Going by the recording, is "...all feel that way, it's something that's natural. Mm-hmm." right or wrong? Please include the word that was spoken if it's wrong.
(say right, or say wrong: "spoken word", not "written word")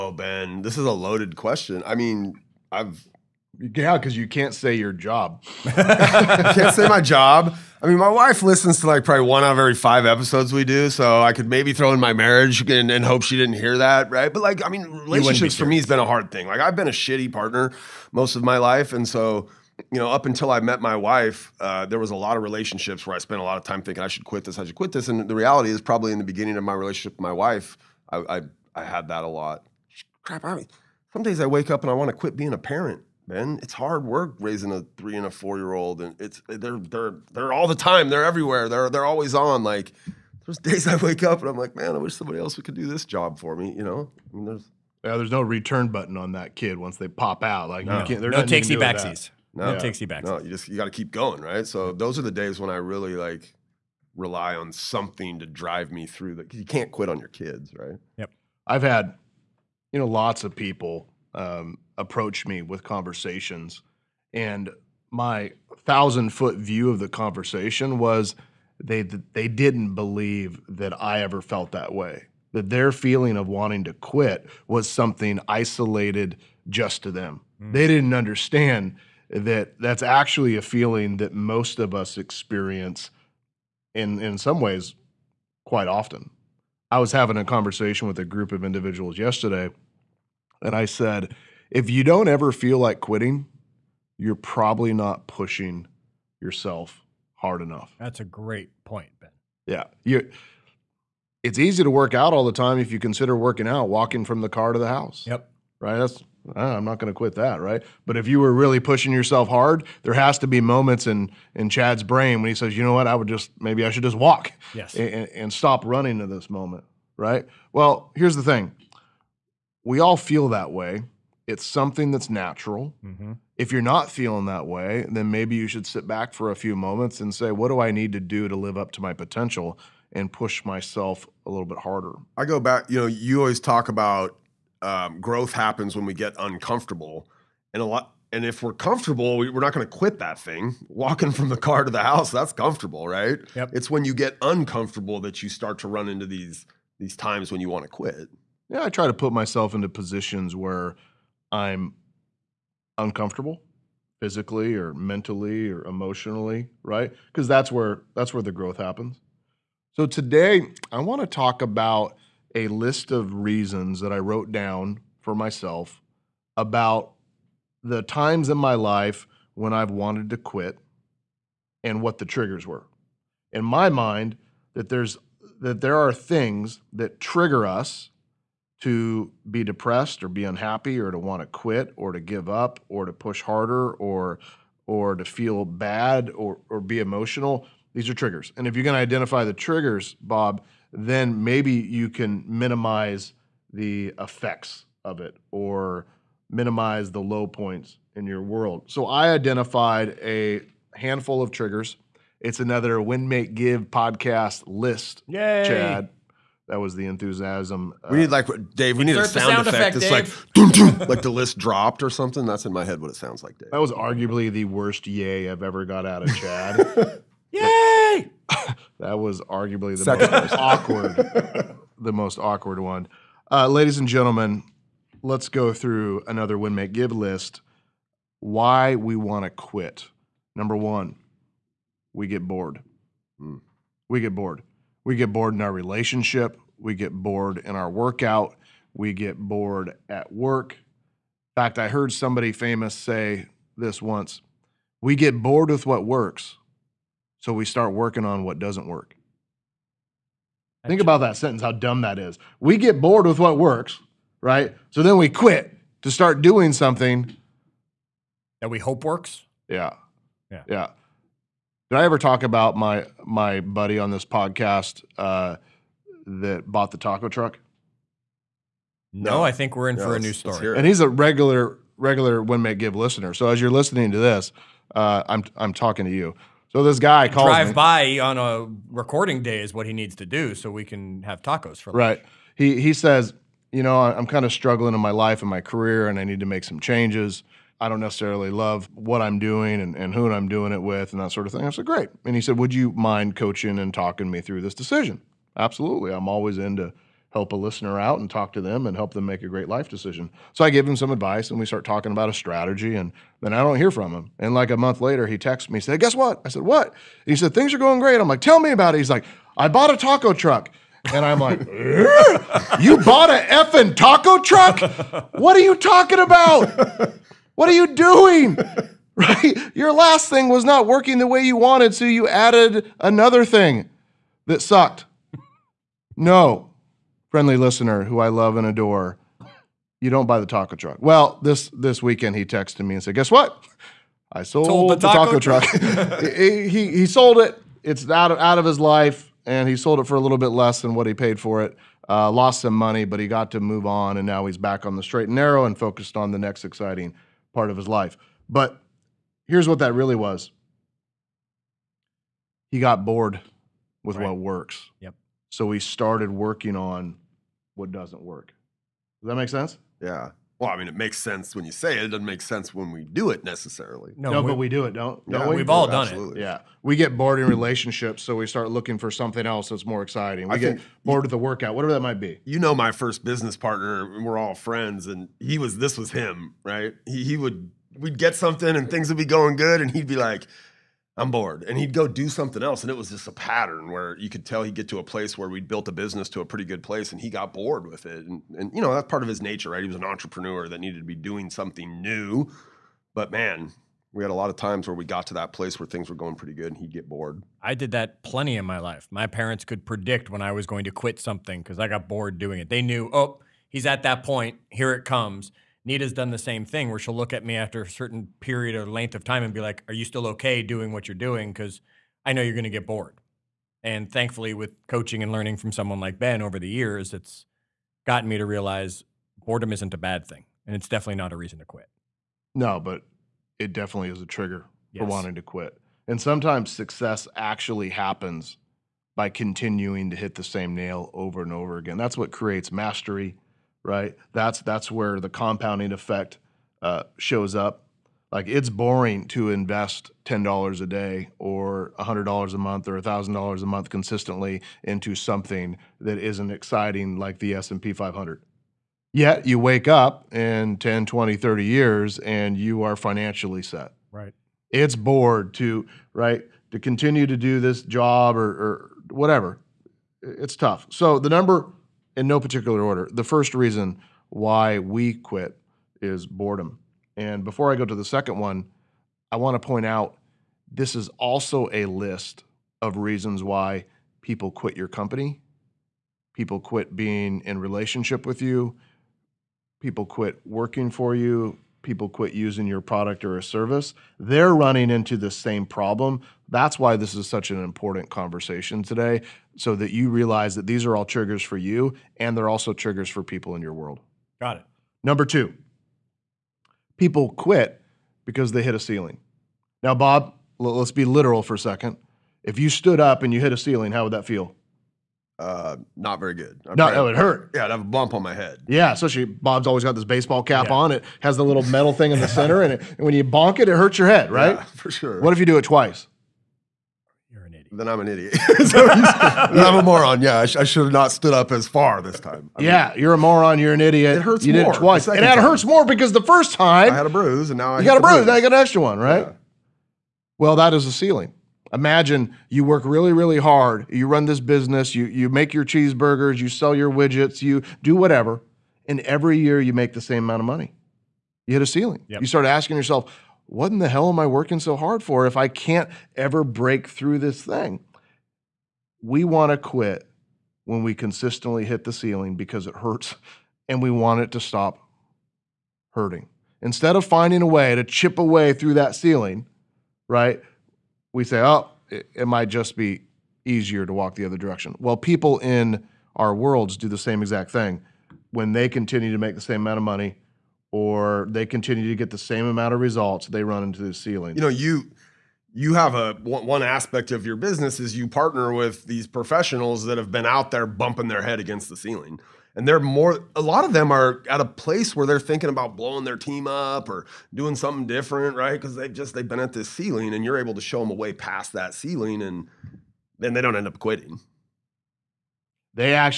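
right.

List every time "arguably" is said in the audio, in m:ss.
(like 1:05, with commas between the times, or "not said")
3:33, 3:39.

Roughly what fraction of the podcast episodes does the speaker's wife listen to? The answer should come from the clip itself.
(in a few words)
1 in 5.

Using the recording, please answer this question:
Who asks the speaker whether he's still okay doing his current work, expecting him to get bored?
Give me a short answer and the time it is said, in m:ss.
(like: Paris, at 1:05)
Nita, at 6:45.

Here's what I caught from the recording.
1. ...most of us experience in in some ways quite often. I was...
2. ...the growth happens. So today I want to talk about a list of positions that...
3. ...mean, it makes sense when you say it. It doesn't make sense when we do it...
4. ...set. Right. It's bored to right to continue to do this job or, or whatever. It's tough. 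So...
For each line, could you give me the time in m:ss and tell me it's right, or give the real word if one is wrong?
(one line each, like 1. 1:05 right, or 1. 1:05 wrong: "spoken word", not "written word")
1. 1:21 right
2. 2:38 wrong: "reasons", not "positions"
3. 6:00 right
4. 7:33 right.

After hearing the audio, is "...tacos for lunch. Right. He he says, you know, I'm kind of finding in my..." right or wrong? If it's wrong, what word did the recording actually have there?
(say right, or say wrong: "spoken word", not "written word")
wrong: "struggling", not "finding".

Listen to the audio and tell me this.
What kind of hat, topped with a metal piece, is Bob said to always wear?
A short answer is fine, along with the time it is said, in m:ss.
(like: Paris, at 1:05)
Baseball cap, at 8:30.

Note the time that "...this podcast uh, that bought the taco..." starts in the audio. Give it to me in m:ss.
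4:24.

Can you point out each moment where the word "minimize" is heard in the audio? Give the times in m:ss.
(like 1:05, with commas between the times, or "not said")
3:12, 3:16.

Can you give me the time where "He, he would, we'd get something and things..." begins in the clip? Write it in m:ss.
6:17.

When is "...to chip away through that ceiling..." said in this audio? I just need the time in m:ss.
9:17.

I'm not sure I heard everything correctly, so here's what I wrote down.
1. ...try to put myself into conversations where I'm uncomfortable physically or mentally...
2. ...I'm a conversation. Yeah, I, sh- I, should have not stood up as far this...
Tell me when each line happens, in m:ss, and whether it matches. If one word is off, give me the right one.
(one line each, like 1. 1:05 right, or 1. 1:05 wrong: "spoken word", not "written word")
1. 2:28 wrong: "positions", not "conversations"
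2. 8:38 wrong: "moron", not "conversation".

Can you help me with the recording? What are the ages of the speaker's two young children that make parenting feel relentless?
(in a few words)
3 and 4.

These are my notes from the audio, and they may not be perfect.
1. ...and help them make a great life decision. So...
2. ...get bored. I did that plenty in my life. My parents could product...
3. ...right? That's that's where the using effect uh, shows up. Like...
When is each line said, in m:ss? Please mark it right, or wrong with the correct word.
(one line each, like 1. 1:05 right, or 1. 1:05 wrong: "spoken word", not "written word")
1. 4:58 right
2. 6:36 wrong: "predict", not "product"
3. 7:13 wrong: "compounding", not "using".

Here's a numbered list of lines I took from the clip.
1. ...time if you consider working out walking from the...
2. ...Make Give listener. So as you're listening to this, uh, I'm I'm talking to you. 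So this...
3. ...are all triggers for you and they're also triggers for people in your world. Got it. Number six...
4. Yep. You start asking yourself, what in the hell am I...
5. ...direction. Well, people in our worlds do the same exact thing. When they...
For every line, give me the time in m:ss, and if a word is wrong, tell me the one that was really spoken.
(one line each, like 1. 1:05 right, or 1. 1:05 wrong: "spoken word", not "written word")
1. 1:42 right
2. 4:32 right
3. 8:10 wrong: "two", not "six"
4. 9:02 right
5. 9:24 right.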